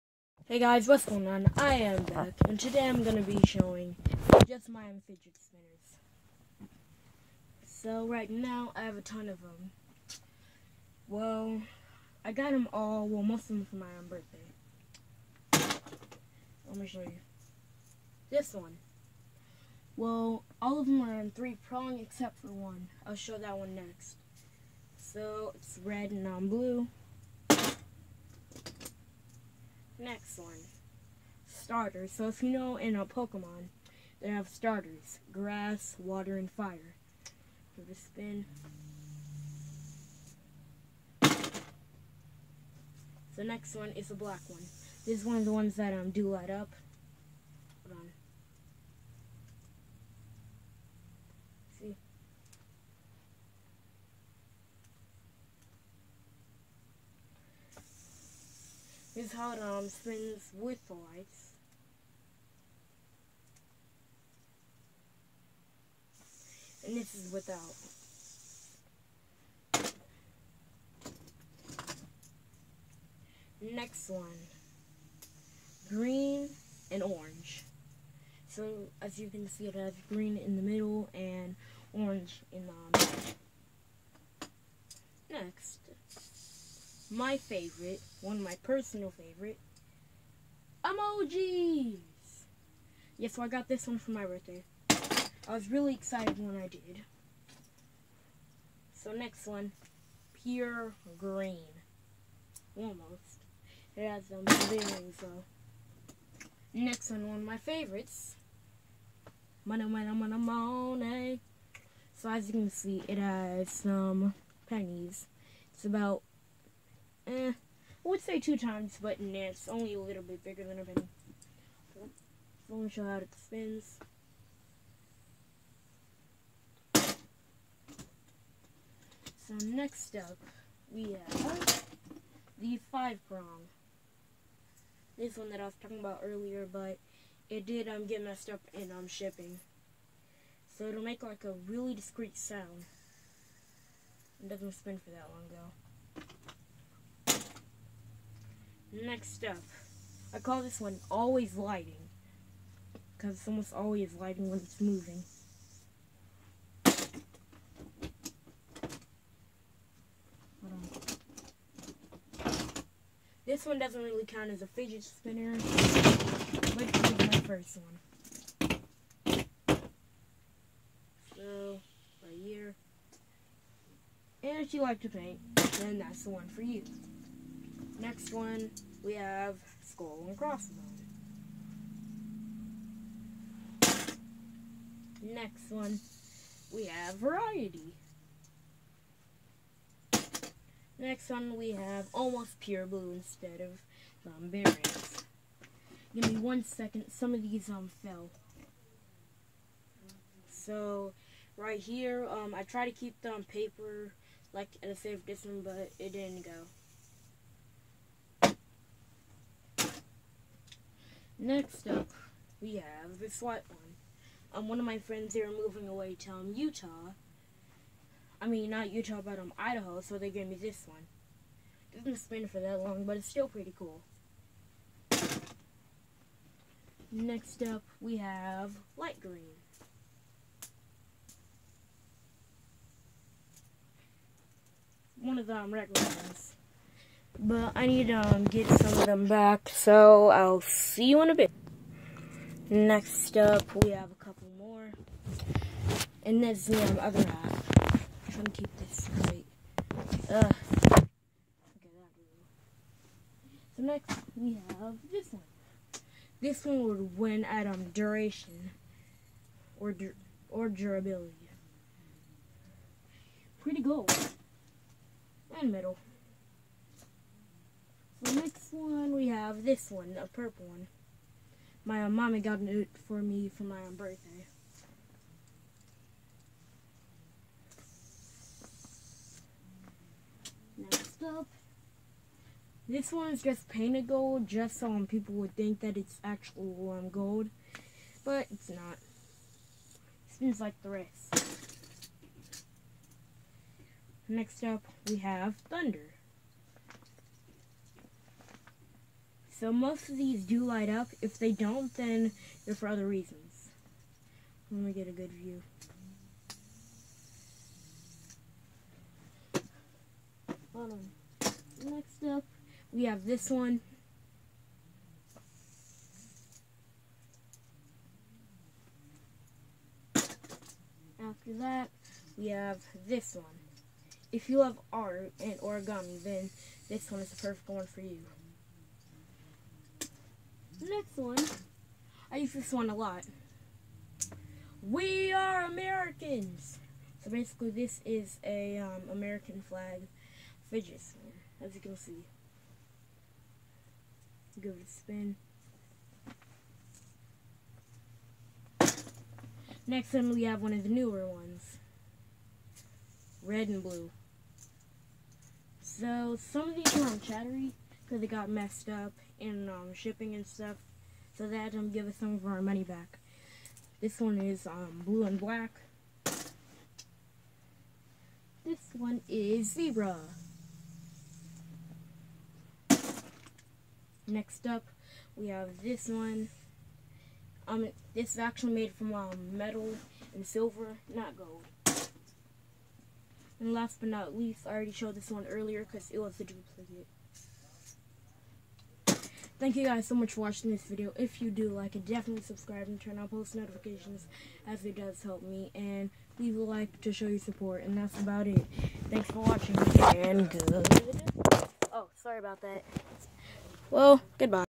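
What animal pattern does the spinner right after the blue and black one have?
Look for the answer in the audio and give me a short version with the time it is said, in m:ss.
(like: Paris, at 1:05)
Zebra, at 6:09.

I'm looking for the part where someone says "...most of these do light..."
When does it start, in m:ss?
4:59.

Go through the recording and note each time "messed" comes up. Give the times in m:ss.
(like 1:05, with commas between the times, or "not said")
2:18, 5:58.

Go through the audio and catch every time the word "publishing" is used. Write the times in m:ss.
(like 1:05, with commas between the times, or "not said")
not said.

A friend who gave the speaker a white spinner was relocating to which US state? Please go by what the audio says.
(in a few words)
Idaho.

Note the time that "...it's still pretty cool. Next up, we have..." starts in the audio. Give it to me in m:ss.
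3:43.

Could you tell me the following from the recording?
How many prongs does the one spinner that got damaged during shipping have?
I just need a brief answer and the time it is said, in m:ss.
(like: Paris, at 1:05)
5, at 2:12.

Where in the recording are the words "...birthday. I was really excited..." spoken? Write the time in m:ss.
1:34.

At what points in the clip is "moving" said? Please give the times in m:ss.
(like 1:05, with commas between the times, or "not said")
2:34, 3:35.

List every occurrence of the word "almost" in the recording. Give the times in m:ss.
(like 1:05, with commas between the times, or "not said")
1:42, 2:33, 3:12.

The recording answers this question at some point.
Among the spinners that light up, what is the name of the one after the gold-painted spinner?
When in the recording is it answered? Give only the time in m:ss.
4:55.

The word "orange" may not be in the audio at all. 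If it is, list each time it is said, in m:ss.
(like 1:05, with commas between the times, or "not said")
1:17, 1:21.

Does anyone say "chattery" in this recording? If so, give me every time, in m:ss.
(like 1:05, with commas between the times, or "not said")
5:57.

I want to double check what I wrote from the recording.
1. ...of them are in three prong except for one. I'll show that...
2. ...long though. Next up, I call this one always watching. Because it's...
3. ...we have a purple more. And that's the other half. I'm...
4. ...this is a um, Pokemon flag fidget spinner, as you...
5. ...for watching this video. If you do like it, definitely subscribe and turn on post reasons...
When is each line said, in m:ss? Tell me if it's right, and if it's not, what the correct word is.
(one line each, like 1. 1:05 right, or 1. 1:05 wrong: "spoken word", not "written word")
1. 0:20 right
2. 2:25 wrong: "lighting", not "watching"
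3. 4:03 wrong: "couple", not "purple"
4. 5:37 wrong: "American", not "Pokemon"
5. 6:30 wrong: "notifications", not "reasons".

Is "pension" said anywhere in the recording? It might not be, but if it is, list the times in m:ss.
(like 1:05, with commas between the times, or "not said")
not said.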